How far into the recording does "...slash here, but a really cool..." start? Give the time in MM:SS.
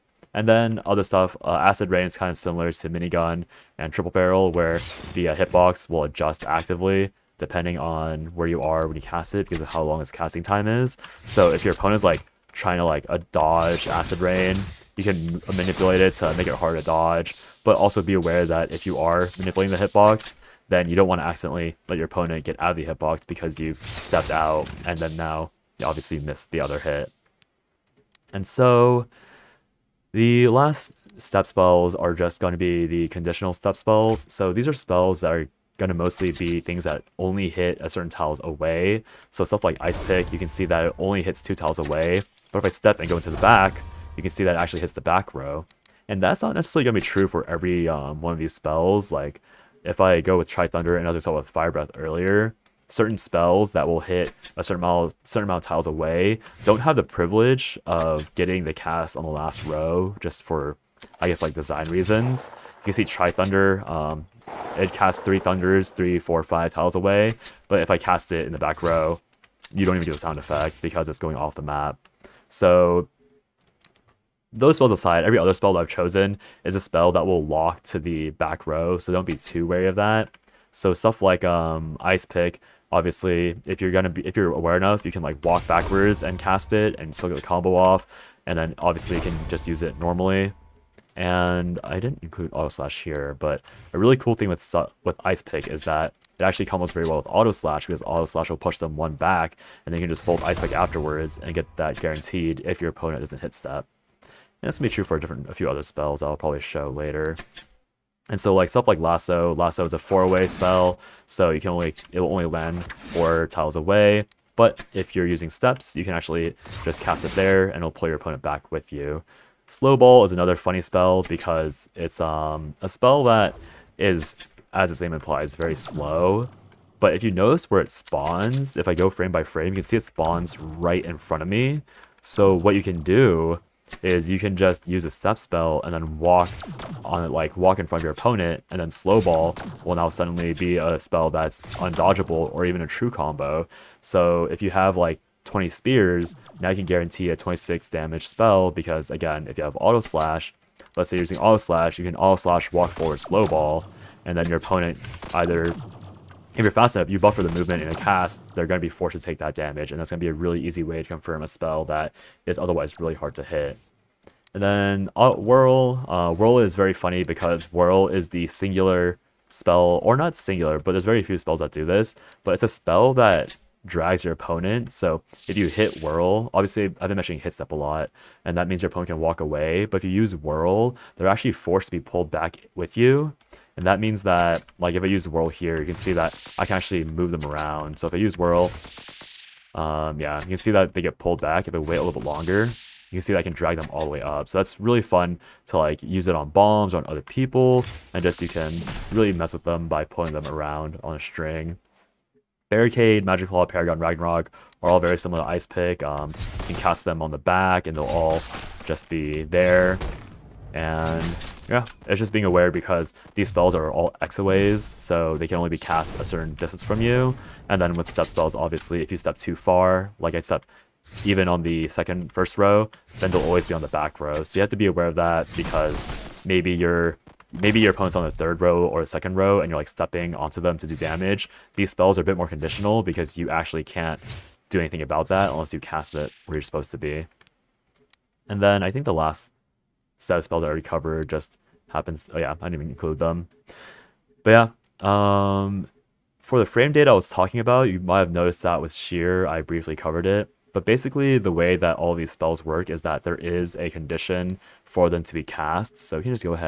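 01:32.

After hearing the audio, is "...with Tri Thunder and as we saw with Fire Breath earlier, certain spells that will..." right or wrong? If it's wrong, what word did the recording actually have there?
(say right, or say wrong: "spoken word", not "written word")
right.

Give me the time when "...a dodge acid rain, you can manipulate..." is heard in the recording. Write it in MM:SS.
00:13.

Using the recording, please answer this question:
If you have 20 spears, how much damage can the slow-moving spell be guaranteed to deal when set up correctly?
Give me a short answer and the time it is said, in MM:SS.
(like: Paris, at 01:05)
26, at 02:27.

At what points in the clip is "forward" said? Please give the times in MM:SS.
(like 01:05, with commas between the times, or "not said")
02:32.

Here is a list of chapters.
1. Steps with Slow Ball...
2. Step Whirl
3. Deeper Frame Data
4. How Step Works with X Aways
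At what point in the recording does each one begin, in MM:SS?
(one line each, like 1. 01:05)
1. 01:58
2. 02:45
3. 03:58
4. 00:28.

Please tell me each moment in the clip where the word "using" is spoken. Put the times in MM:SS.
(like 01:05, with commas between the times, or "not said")
01:55, 02:31.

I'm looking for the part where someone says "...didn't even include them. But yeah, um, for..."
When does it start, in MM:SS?
04:02.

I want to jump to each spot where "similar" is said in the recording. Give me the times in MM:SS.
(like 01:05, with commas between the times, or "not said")
00:02, 03:25.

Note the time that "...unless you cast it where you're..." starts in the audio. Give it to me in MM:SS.
03:55.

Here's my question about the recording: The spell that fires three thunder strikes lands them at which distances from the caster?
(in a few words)
3, 4, 5 tiles.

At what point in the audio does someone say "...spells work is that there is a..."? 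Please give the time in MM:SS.
04:12.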